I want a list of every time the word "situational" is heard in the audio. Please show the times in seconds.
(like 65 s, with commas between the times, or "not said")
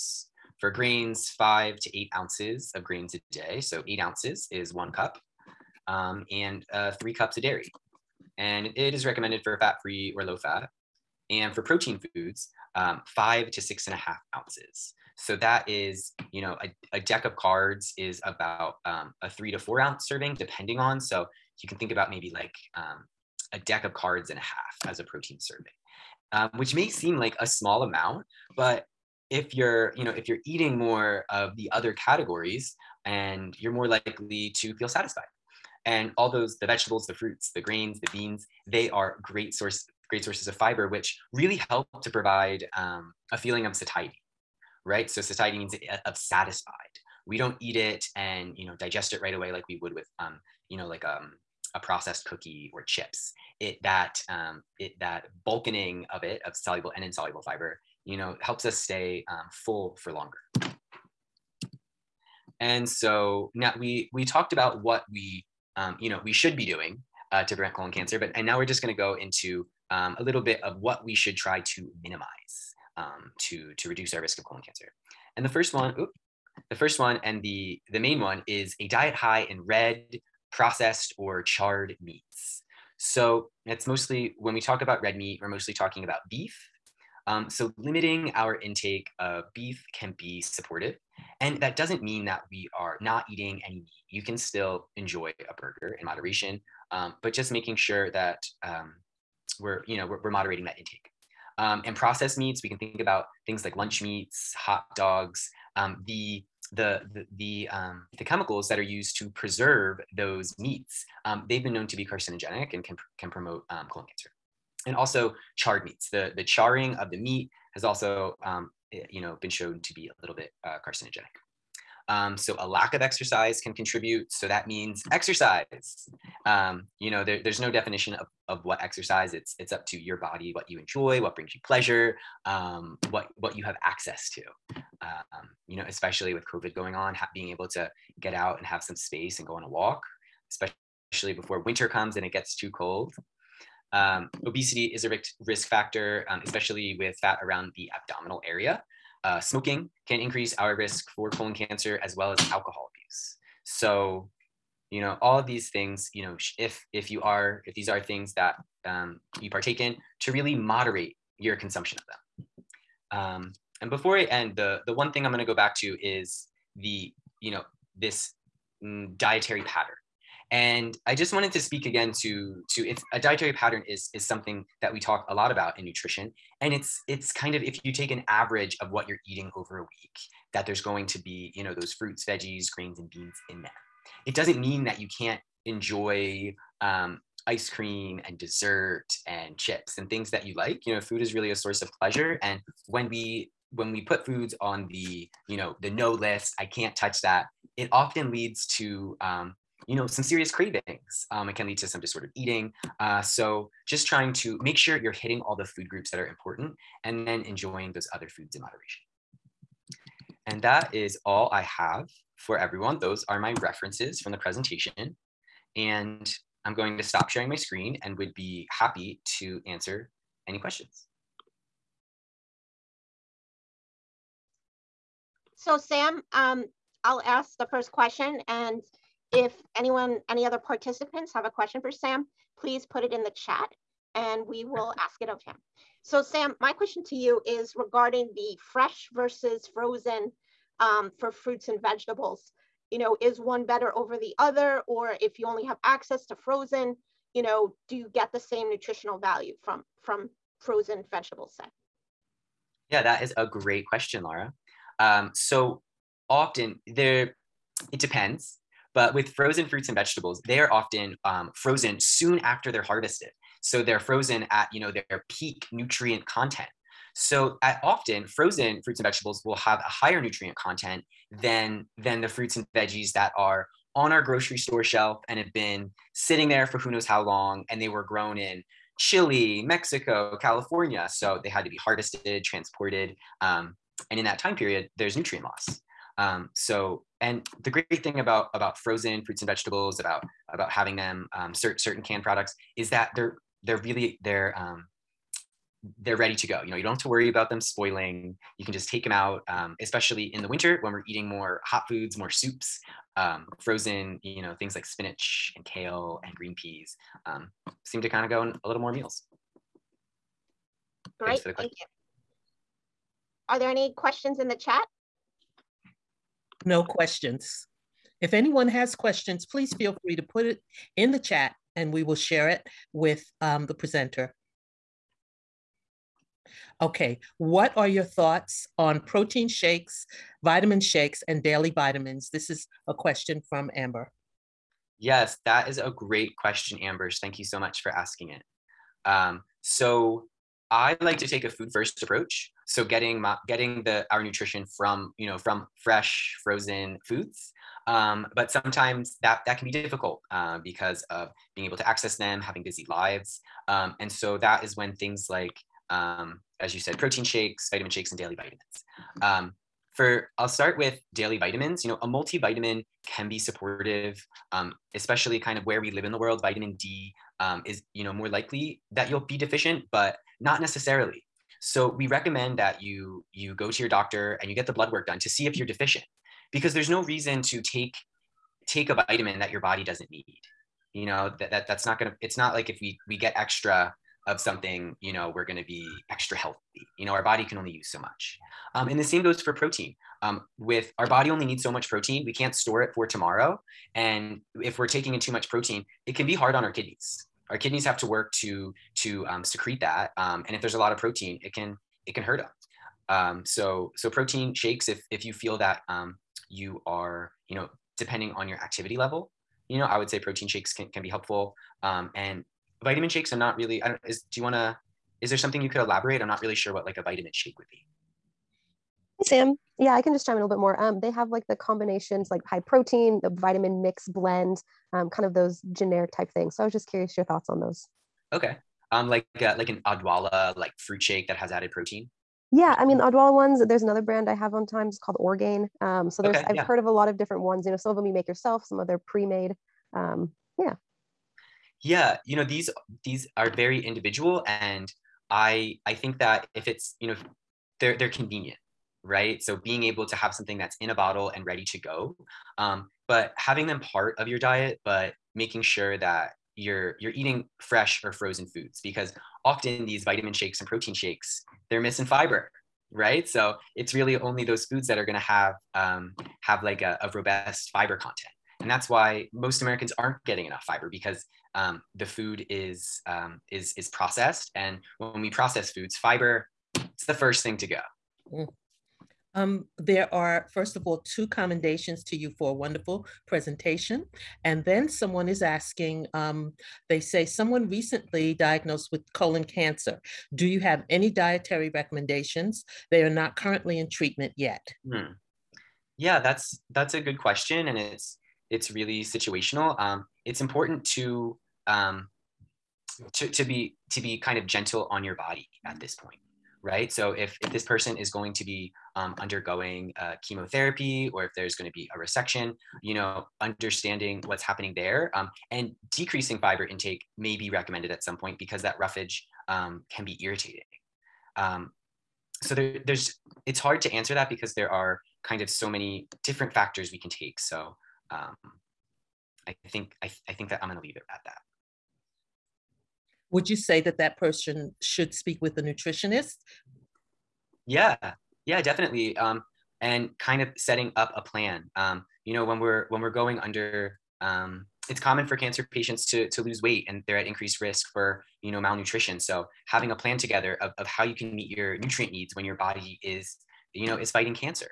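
499 s.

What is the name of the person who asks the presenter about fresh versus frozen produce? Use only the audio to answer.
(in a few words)
Laura.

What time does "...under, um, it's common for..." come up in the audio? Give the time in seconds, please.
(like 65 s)
543 s.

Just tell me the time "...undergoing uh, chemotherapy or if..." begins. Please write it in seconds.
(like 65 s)
509 s.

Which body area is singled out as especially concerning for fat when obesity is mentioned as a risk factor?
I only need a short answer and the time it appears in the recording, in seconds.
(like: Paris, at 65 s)
Abdominal area, at 147 s.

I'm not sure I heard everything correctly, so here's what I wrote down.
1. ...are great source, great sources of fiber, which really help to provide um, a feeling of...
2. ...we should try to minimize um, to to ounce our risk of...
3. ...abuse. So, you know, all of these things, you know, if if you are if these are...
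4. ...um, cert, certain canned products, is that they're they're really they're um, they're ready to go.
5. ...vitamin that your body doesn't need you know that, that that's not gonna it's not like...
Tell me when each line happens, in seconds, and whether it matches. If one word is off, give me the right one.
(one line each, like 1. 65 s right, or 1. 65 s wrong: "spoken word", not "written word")
1. 38 s right
2. 71 s wrong: "reduce", not "ounce"
3. 152 s right
4. 291 s right
5. 378 s right.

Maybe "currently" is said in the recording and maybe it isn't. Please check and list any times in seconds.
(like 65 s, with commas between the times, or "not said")
493 s.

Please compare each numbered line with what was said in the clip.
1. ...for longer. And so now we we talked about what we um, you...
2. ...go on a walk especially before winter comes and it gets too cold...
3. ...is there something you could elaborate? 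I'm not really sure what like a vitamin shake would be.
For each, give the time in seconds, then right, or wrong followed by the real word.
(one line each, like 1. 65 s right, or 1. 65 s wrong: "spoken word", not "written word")
1. 59 s right
2. 139 s right
3. 415 s right.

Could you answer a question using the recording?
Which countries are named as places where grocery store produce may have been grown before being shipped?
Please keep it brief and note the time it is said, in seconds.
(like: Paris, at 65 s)
Chile, Mexico, at 278 s.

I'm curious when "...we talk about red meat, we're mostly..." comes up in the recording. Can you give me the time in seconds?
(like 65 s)
84 s.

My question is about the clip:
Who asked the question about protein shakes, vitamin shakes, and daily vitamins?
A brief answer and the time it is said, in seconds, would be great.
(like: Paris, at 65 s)
Amber, at 333 s.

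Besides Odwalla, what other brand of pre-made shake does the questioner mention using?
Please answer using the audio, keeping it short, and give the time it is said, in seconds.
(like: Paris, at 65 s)
Orgain, at 435 s.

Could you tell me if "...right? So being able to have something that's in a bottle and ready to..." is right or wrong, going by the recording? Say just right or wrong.
right.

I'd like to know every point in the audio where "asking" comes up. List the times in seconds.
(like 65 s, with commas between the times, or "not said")
337 s, 485 s.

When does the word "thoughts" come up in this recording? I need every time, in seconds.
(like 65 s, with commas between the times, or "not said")
328 s, 427 s.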